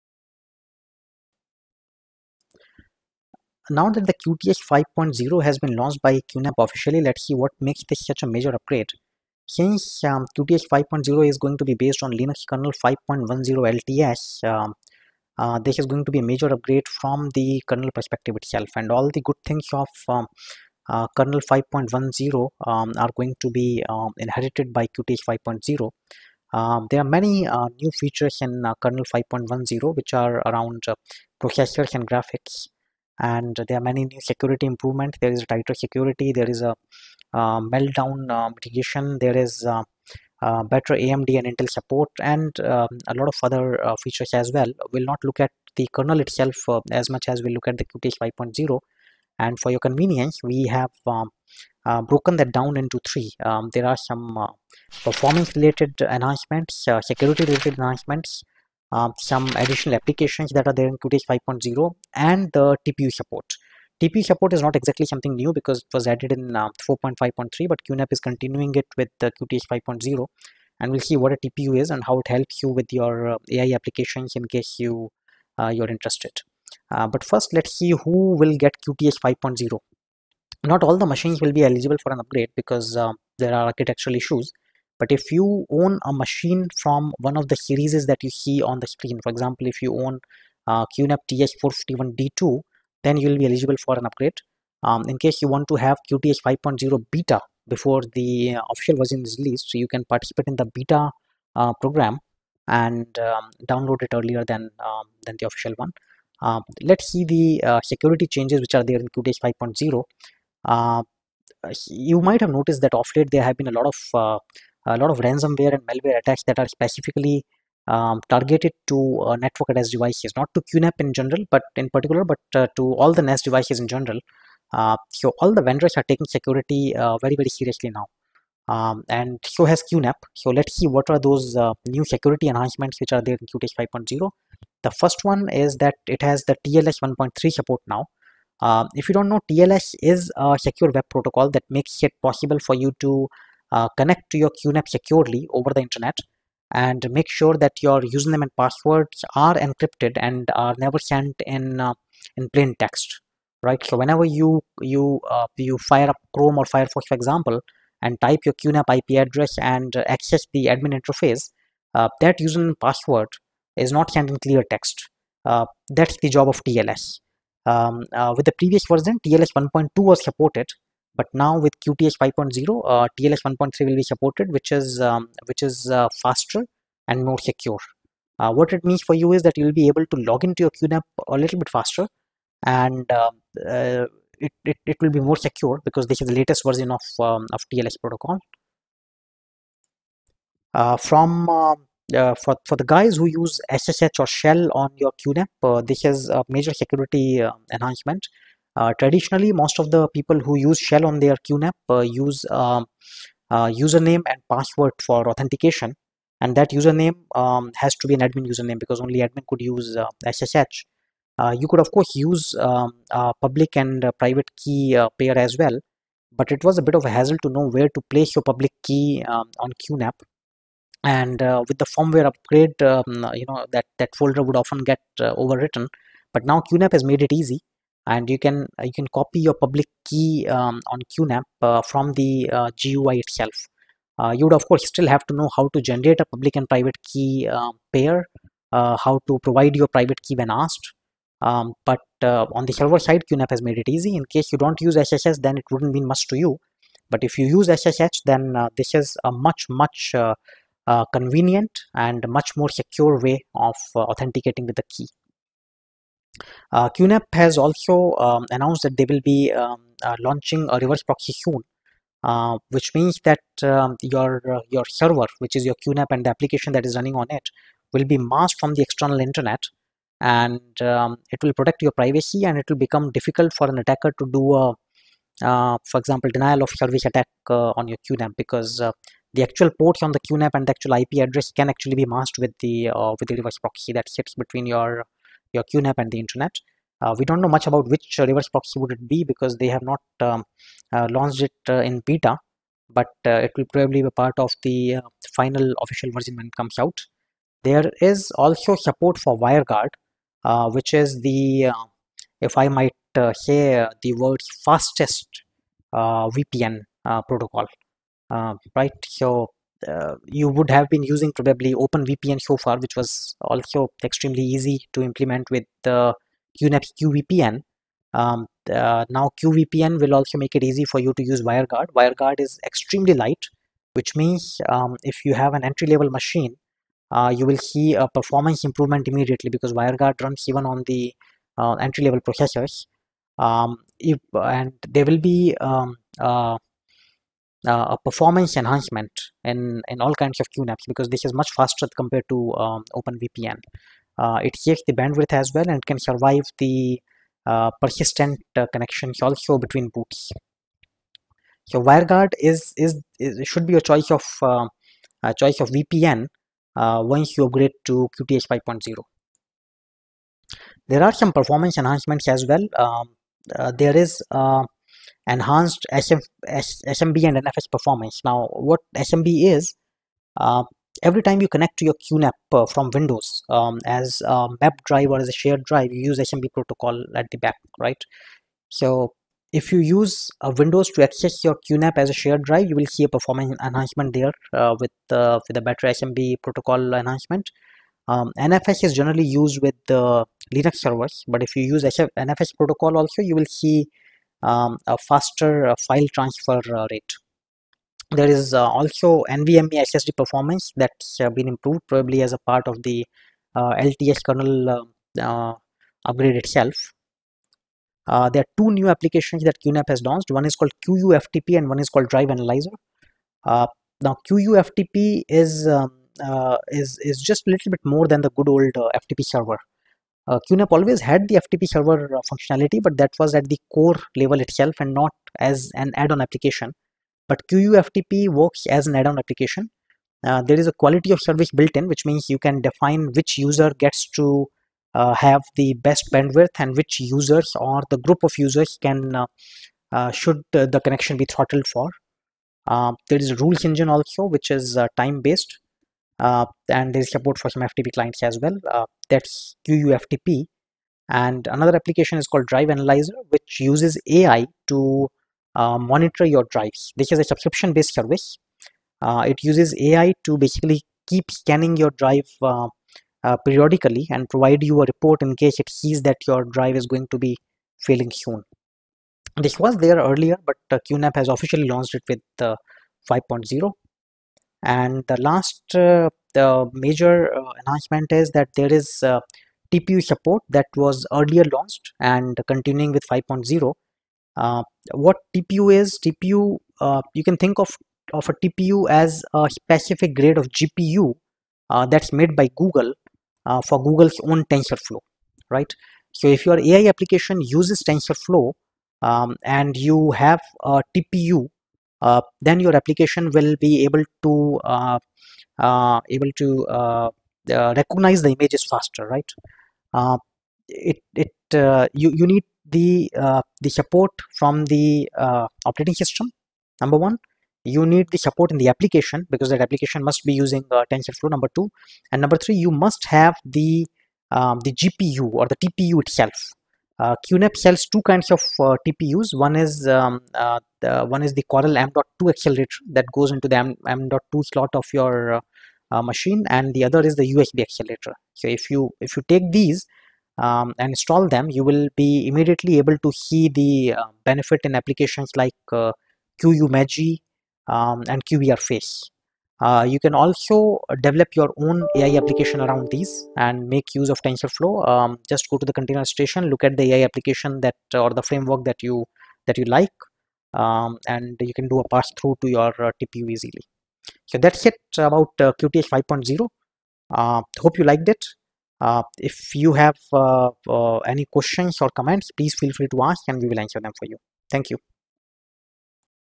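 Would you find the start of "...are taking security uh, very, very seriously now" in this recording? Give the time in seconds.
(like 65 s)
125 s.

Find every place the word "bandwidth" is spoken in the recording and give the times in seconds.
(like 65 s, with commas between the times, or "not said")
344 s, 436 s.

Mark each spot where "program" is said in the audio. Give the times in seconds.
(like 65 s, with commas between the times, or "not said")
101 s.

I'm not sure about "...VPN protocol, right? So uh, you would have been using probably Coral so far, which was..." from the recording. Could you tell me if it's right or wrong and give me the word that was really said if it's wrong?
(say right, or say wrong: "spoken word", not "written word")
wrong: "OpenVPN", not "Coral".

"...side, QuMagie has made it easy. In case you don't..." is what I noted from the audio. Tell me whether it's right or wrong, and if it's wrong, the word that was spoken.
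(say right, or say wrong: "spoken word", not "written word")
wrong: "QNAP", not "QuMagie".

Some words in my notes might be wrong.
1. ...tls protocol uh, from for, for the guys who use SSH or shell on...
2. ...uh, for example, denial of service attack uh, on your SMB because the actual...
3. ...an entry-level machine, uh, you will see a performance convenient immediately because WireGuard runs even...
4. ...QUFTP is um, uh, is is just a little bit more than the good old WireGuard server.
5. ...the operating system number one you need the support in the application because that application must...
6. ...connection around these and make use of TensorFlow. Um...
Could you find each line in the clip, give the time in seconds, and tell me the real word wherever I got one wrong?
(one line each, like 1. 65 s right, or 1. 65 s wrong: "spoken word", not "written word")
1. 187 s right
2. 275 s wrong: "QNAP", not "SMB"
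3. 325 s wrong: "improvement", not "convenient"
4. 414 s wrong: "FTP", not "WireGuard"
5. 514 s right
6. 552 s wrong: "application", not "connection".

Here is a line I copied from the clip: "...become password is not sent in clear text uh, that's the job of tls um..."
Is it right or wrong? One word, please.
wrong.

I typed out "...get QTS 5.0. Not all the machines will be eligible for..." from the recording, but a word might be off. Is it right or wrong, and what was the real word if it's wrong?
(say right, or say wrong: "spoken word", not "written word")
right.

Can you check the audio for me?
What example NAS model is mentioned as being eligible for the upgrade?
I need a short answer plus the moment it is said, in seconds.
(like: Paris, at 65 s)
TS451D2, at 91 s.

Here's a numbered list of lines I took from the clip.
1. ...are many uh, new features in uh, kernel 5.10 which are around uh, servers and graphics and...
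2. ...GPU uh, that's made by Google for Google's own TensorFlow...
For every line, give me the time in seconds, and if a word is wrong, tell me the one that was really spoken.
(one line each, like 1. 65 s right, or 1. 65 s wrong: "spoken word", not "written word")
1. 26 s wrong: "processors", not "servers"
2. 490 s right.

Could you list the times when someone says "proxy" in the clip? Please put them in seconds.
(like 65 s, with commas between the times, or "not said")
261 s, 283 s, 288 s.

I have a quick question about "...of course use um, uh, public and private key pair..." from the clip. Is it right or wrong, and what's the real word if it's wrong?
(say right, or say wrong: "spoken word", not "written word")
right.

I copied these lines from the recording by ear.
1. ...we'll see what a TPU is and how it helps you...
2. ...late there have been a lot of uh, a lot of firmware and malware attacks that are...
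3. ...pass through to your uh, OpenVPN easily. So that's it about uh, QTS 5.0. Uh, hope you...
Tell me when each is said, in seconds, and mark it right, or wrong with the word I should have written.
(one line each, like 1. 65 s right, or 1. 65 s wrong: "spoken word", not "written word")
1. 70 s right
2. 113 s wrong: "ransomware", not "firmware"
3. 561 s wrong: "TPU", not "OpenVPN".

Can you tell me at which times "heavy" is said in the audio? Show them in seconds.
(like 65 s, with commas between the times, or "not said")
not said.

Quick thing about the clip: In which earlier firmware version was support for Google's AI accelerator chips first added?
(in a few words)
4.5.3.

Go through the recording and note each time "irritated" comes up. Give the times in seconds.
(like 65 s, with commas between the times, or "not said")
not said.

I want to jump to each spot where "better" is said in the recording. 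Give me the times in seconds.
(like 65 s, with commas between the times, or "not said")
40 s, 385 s.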